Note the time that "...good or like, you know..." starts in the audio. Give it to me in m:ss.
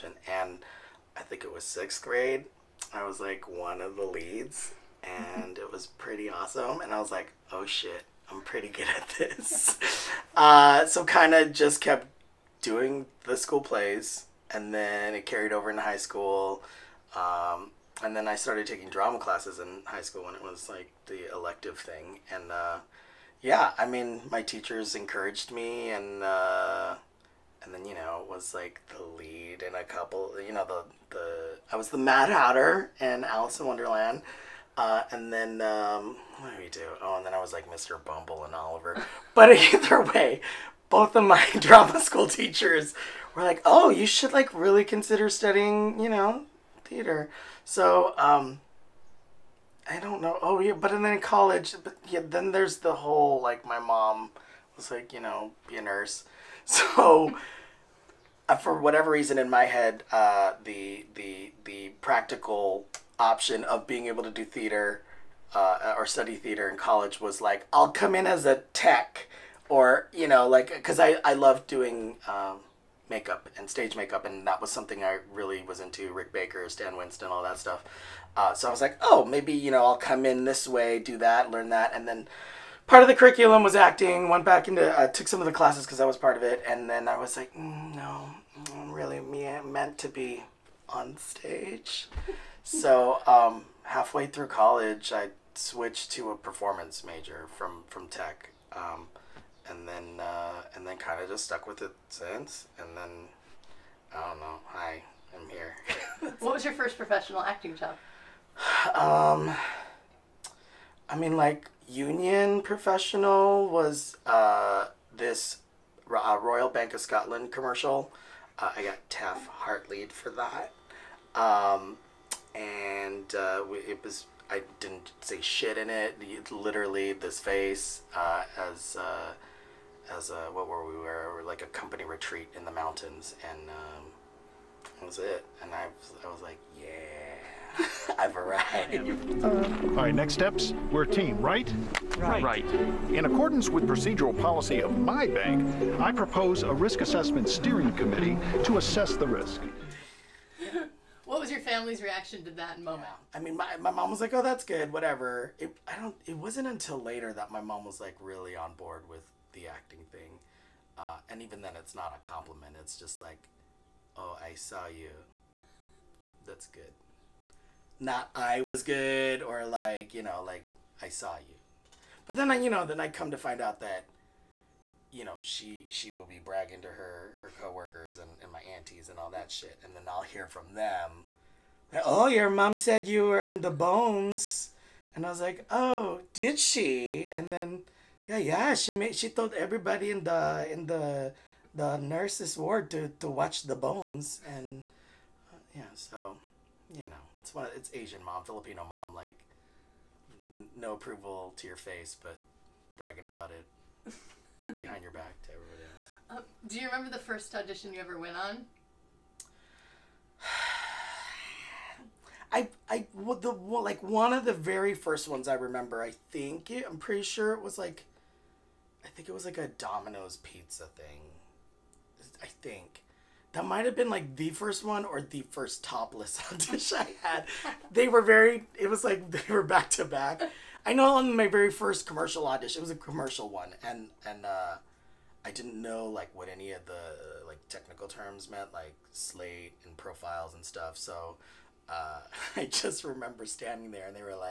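2:48.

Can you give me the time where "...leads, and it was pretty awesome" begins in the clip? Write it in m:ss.
0:04.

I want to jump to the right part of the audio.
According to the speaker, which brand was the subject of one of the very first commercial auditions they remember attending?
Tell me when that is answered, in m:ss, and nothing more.
3:39.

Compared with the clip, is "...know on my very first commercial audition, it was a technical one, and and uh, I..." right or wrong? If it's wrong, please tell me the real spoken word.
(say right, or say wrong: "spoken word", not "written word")
wrong: "commercial", not "technical".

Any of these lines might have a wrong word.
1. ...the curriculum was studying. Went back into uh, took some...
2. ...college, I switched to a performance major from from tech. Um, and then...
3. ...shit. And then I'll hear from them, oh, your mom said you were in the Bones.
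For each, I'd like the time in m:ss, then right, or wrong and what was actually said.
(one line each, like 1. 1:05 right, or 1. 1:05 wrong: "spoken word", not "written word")
1. 1:23 wrong: "acting", not "studying"
2. 1:34 right
3. 2:59 right.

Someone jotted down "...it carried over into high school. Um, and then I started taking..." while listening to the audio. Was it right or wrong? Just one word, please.
right.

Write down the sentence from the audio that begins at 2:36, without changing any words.
It wasn't until later that my mom was like really on board with the acting thing.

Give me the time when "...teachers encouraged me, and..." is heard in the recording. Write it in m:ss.
0:24.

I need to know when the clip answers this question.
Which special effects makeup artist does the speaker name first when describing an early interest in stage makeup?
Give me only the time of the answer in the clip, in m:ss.
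1:16.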